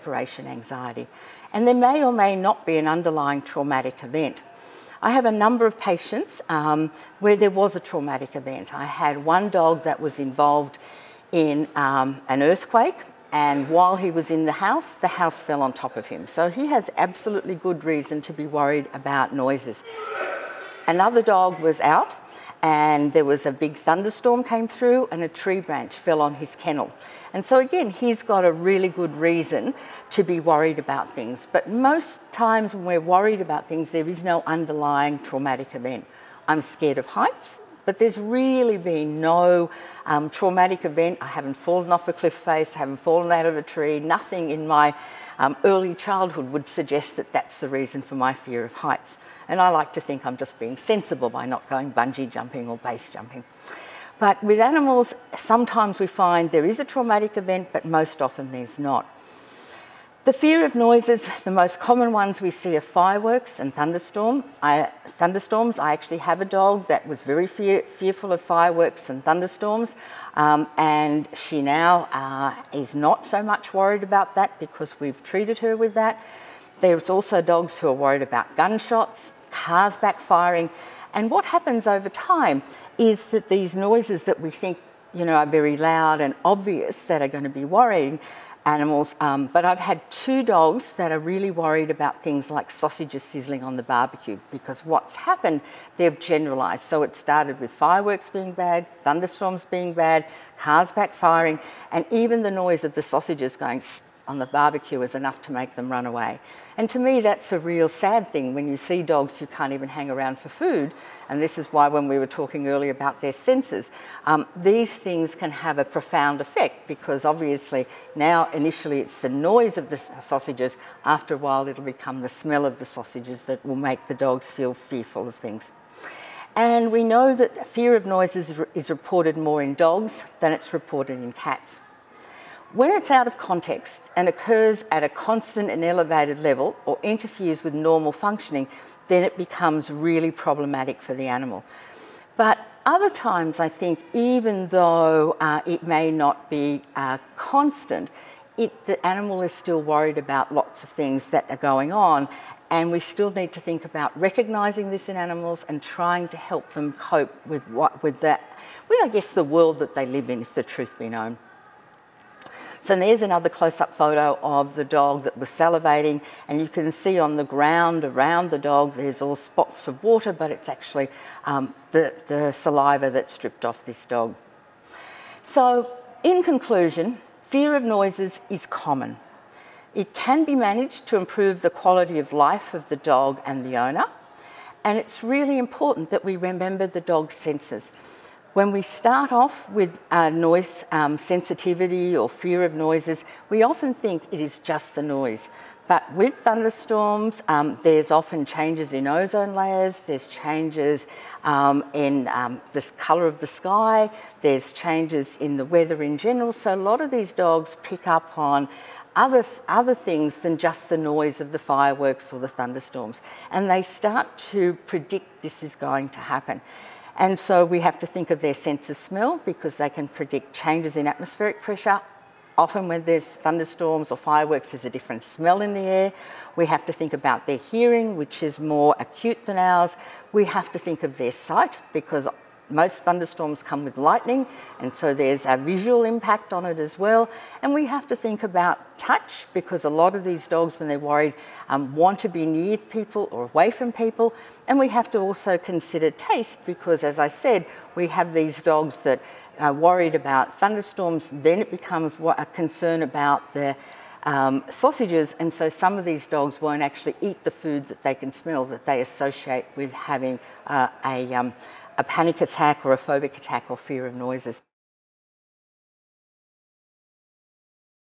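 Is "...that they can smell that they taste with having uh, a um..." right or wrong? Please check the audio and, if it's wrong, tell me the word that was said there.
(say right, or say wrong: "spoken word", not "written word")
wrong: "associate", not "taste".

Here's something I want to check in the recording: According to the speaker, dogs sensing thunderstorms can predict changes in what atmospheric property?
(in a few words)
atmospheric pressure.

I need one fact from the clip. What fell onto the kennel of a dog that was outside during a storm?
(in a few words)
tree branch.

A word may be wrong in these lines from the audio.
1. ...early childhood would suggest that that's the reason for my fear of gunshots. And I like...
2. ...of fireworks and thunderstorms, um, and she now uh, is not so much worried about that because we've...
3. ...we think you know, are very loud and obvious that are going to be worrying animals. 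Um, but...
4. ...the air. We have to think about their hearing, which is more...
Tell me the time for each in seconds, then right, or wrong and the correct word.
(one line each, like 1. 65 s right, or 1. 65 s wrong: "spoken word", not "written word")
1. 45 s wrong: "heights", not "gunshots"
2. 68 s right
3. 84 s right
4. 225 s right.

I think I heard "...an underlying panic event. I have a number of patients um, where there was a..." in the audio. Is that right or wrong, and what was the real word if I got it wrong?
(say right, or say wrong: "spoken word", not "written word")
wrong: "traumatic", not "panic".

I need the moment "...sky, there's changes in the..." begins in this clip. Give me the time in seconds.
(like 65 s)
203 s.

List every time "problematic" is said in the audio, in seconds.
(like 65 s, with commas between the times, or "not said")
140 s.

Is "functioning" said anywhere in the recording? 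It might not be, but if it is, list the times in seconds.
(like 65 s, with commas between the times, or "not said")
138 s.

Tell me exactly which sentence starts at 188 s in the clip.
When we start off with uh, noise um, sensitivity or fear of noises, we often think it is just the noise.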